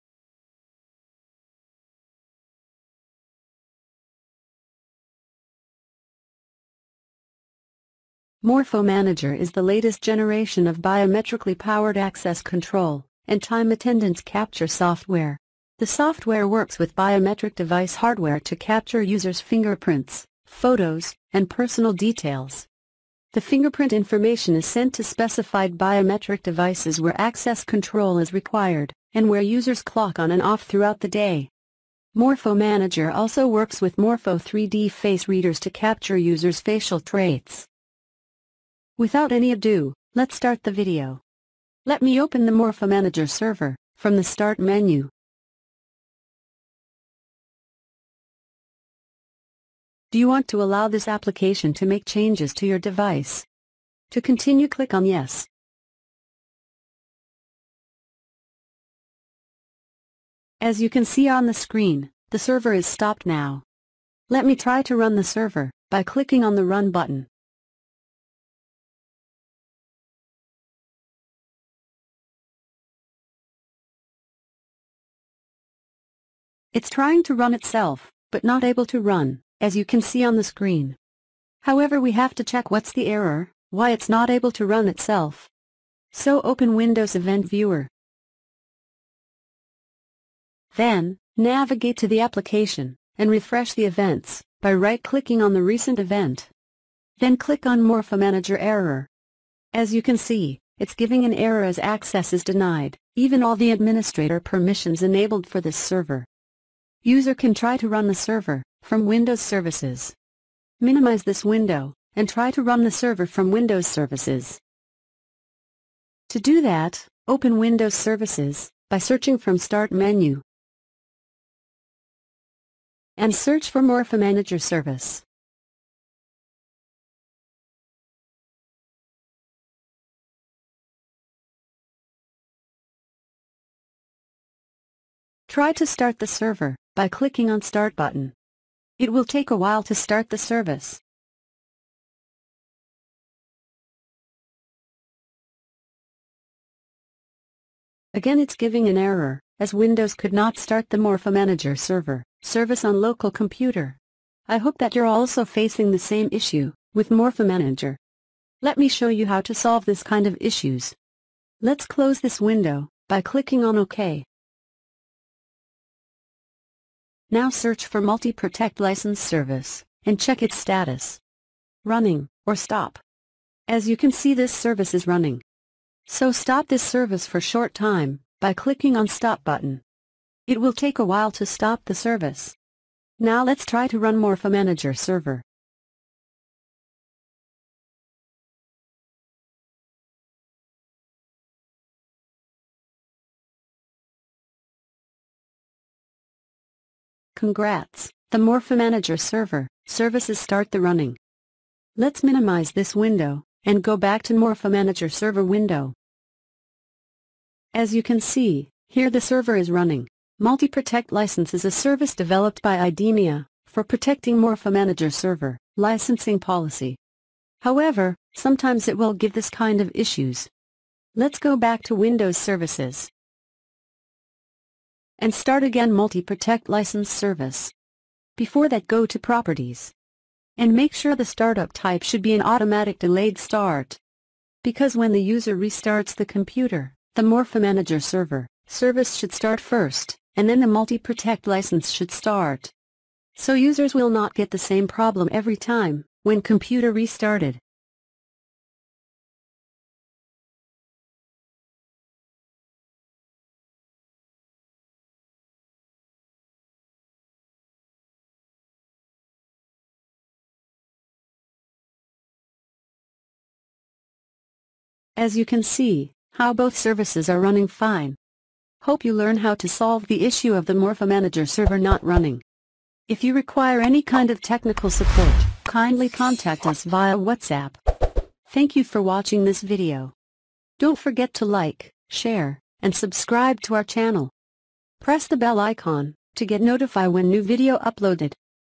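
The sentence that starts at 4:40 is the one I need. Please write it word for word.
Don't forget to like, share, and subscribe to our channel.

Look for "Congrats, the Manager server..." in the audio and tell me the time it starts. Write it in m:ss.
3:17.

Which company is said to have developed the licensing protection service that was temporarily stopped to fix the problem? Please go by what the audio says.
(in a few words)
IDEMIA.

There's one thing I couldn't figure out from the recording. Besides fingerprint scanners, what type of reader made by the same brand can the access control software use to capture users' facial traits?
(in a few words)
Morpho 3D face readers.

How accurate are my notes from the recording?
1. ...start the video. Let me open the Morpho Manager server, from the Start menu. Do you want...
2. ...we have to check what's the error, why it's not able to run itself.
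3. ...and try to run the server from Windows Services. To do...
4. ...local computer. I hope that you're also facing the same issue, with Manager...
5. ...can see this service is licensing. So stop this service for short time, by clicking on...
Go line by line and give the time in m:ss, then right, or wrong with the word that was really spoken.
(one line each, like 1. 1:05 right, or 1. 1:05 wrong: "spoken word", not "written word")
1. 0:40 right
2. 1:21 right
3. 1:52 right
4. 2:32 wrong: "Morpho", not "Manager"
5. 2:53 wrong: "running", not "licensing".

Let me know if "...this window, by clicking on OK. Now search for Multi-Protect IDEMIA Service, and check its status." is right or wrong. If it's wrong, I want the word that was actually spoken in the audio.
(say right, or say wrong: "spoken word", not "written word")
wrong: "License", not "IDEMIA".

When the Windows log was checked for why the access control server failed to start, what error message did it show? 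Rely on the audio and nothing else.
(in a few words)
access is denied.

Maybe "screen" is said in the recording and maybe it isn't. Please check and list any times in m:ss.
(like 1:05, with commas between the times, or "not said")
1:01, 1:20.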